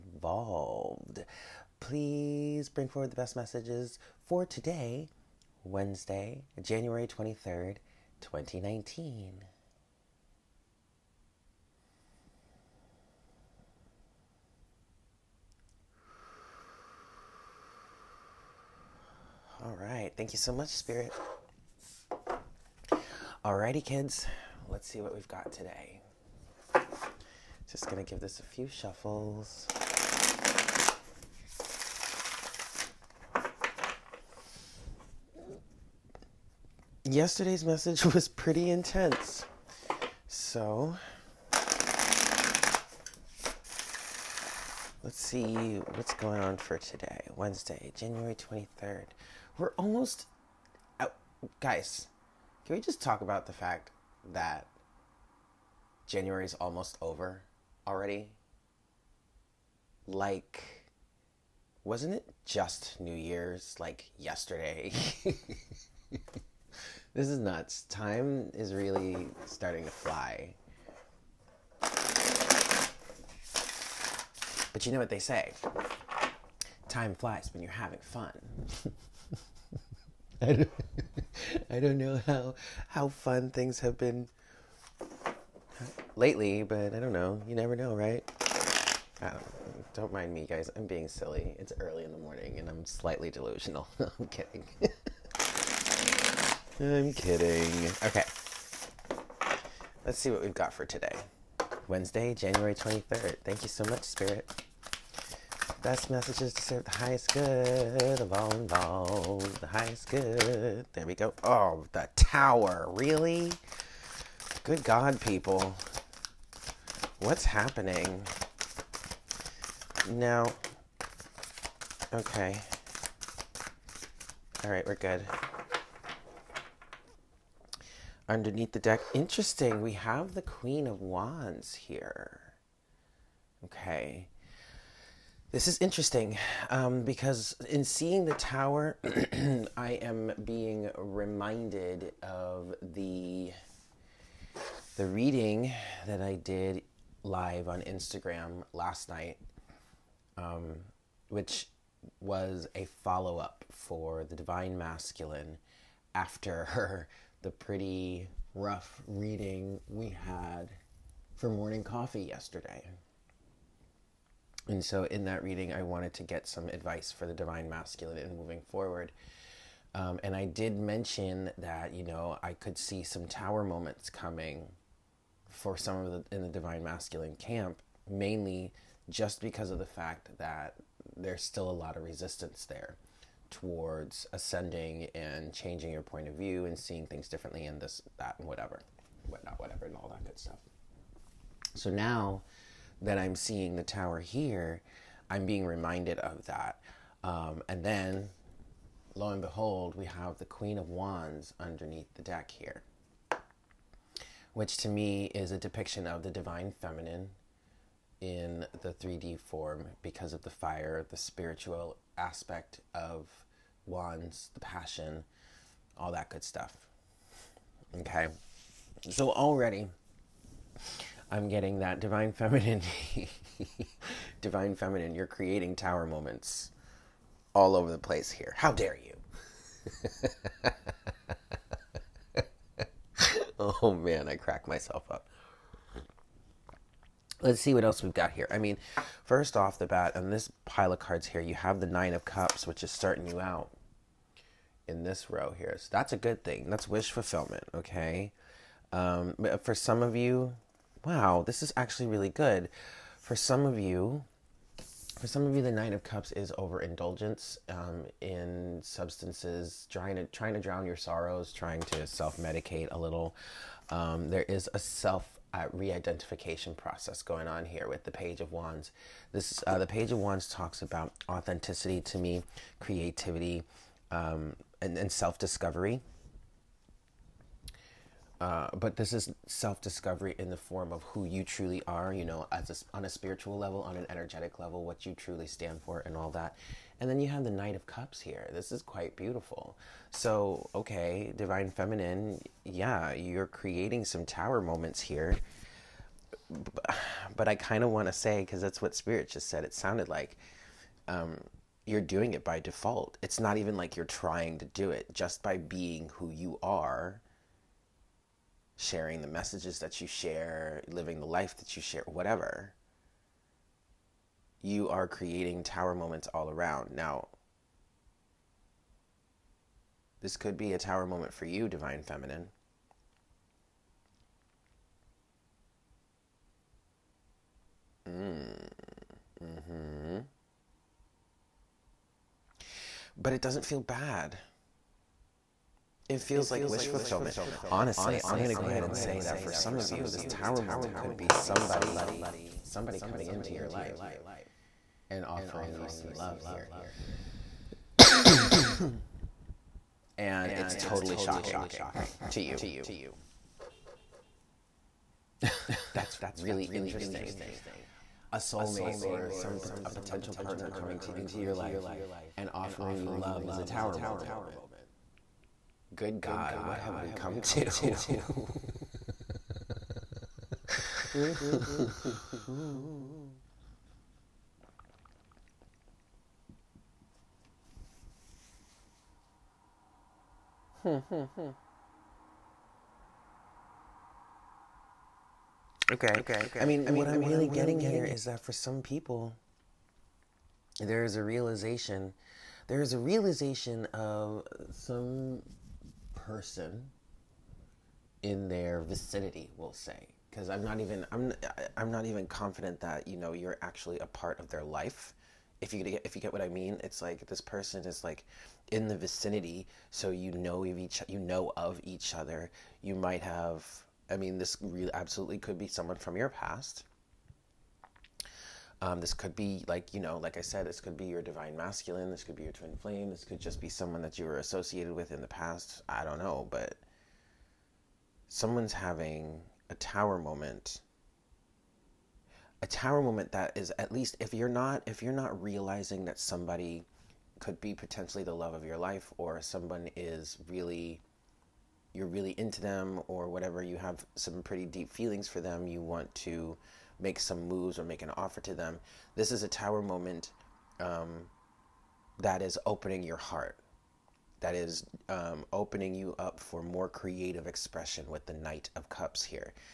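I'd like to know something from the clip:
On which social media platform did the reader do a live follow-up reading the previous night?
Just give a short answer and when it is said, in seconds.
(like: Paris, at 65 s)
Instagram, at 147 s.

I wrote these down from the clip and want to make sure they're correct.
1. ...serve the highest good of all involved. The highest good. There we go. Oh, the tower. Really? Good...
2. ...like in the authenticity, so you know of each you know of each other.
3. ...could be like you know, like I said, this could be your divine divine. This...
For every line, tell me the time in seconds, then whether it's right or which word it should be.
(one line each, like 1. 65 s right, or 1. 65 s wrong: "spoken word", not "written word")
1. 106 s right
2. 408 s wrong: "vicinity", not "authenticity"
3. 419 s wrong: "masculine", not "divine".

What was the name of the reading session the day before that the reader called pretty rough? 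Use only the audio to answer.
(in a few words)
morning coffee.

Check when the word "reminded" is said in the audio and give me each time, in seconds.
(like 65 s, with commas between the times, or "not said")
140 s, 195 s.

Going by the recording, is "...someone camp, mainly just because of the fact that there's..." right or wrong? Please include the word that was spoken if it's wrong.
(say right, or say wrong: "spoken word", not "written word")
wrong: "masculine", not "someone".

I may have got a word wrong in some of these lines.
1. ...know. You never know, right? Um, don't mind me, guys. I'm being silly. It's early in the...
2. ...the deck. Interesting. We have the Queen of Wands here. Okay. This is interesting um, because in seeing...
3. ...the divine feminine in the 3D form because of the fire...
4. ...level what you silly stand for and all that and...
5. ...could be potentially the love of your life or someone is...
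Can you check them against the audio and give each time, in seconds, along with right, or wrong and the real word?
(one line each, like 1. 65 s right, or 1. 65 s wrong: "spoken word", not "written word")
1. 87 s right
2. 128 s right
3. 206 s right
4. 284 s wrong: "truly", not "silly"
5. 437 s right.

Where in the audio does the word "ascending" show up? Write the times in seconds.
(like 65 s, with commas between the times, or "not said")
184 s.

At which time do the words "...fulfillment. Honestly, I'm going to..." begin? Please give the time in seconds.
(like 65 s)
336 s.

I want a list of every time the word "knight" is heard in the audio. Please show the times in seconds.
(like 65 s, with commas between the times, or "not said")
287 s, 458 s.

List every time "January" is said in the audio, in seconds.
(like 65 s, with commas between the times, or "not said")
6 s, 47 s, 56 s, 102 s.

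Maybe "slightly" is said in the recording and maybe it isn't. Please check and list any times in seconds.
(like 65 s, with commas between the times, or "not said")
92 s.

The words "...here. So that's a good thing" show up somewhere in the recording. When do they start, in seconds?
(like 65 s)
245 s.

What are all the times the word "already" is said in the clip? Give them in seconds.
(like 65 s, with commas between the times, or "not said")
57 s, 219 s.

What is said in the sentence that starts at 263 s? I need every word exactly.
Um, there is a self uh, re-identification process going on here with the Page of Wands.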